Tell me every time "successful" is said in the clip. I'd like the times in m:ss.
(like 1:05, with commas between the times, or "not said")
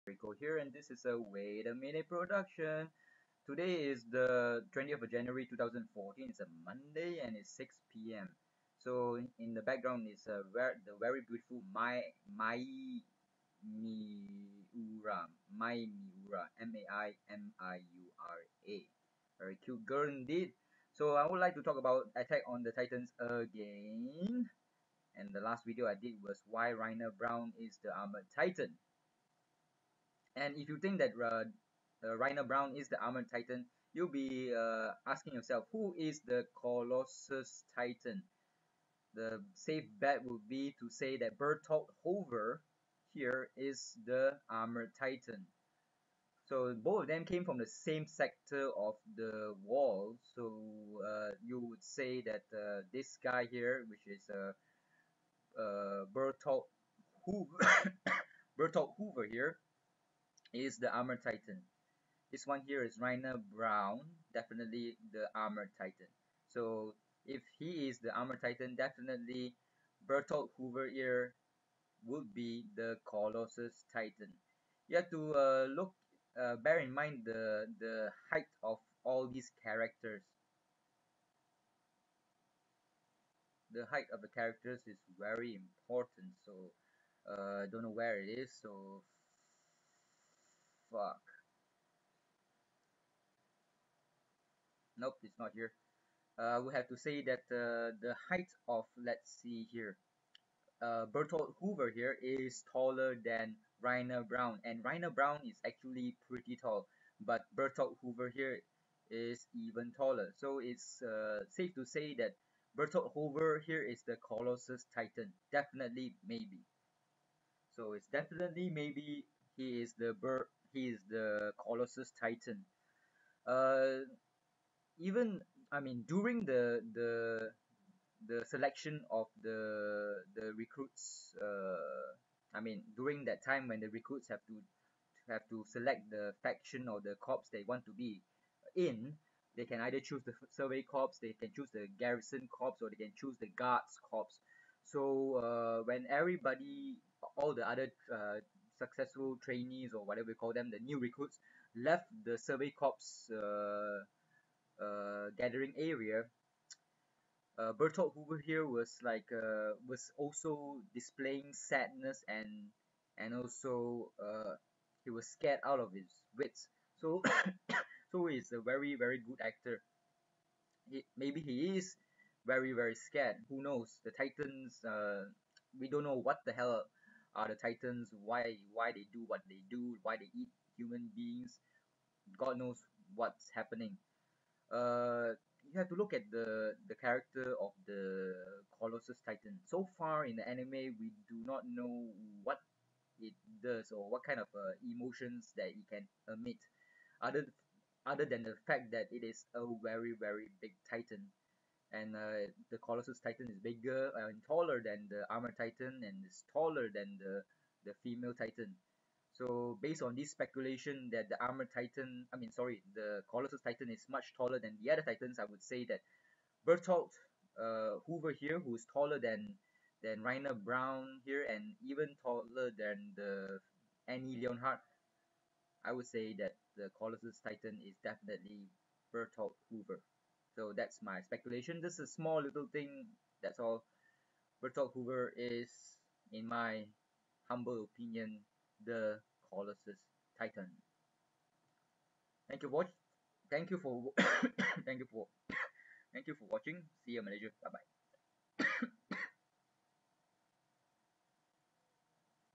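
2:28.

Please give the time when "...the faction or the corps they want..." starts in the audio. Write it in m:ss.
2:16.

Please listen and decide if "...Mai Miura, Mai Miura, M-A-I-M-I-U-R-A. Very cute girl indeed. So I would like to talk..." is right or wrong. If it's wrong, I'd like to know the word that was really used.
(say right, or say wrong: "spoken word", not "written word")
right.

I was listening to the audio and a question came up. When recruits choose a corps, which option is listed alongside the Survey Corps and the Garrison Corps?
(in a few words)
Guards Corps.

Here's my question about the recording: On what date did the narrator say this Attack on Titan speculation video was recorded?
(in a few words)
20 January 2014.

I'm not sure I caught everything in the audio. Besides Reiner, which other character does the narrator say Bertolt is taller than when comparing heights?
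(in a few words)
Annie Leonhart.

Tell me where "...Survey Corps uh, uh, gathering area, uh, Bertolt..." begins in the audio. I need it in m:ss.
2:32.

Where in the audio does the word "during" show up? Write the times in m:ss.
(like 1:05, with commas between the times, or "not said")
2:06, 2:12.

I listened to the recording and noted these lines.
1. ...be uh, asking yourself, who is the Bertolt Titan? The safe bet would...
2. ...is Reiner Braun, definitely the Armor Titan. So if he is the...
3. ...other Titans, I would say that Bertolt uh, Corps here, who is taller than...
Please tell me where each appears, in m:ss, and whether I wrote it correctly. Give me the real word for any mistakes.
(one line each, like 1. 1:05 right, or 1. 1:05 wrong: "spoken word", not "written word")
1. 0:34 wrong: "Colossus", not "Bertolt"
2. 1:02 right
3. 3:34 wrong: "Hoover", not "Corps".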